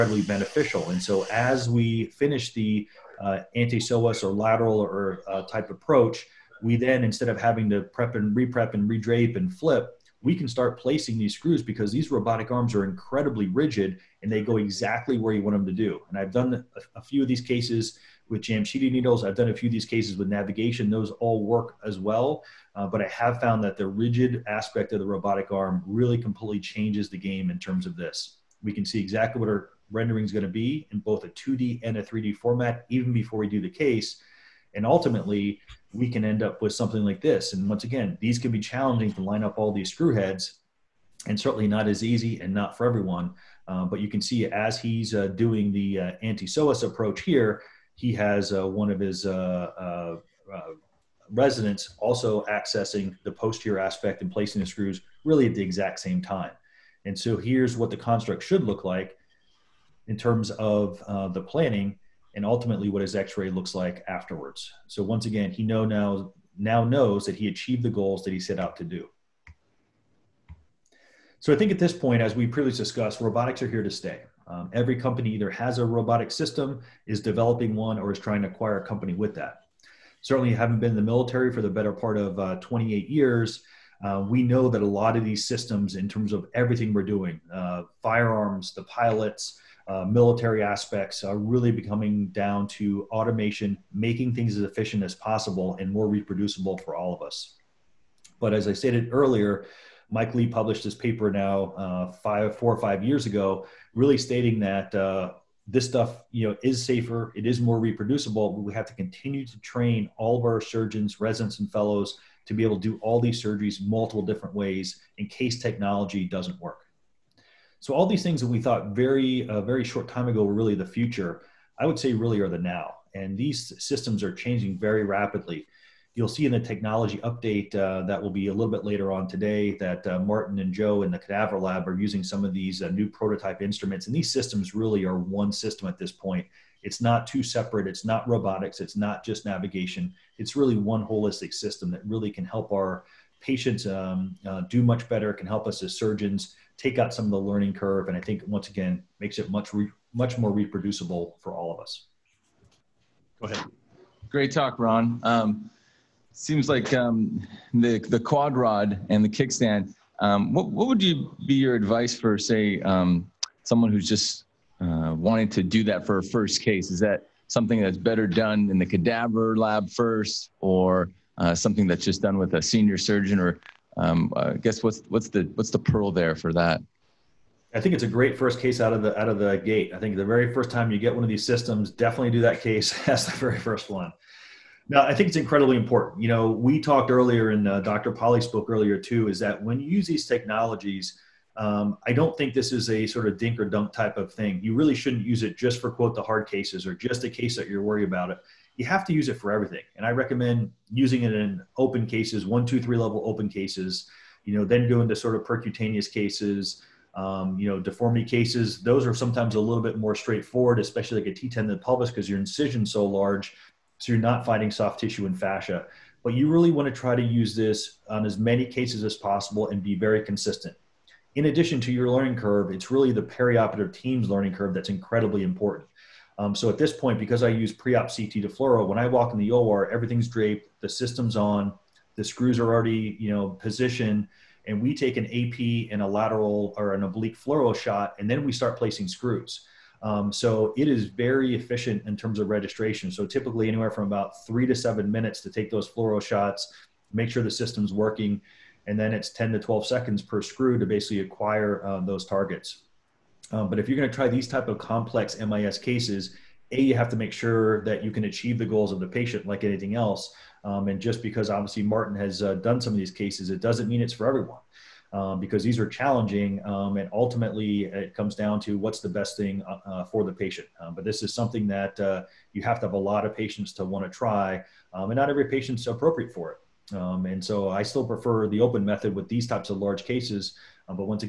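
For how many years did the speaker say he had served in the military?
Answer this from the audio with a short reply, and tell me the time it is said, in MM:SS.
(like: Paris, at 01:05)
28, at 01:22.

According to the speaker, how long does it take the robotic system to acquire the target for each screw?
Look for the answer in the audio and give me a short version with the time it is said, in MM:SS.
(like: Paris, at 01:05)
10 to 12 seconds, at 04:09.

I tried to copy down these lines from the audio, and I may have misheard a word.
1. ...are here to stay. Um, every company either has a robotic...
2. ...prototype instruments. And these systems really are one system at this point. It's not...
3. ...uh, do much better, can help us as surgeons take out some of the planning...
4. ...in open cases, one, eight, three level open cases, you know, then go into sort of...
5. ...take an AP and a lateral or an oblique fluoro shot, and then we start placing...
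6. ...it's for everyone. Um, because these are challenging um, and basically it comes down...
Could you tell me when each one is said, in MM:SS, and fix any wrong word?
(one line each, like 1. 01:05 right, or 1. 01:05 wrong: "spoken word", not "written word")
1. 01:13 right
2. 02:13 right
3. 02:24 wrong: "learning", not "planning"
4. 03:21 wrong: "two", not "eight"
5. 03:54 right
6. 04:24 wrong: "ultimately", not "basically".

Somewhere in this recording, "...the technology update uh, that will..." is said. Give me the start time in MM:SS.
02:06.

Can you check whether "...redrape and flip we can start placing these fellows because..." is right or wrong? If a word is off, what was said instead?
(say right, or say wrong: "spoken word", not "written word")
wrong: "screws", not "fellows".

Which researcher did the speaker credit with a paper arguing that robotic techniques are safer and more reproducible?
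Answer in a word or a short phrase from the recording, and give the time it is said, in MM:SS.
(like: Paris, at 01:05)
Mike Lee, at 01:40.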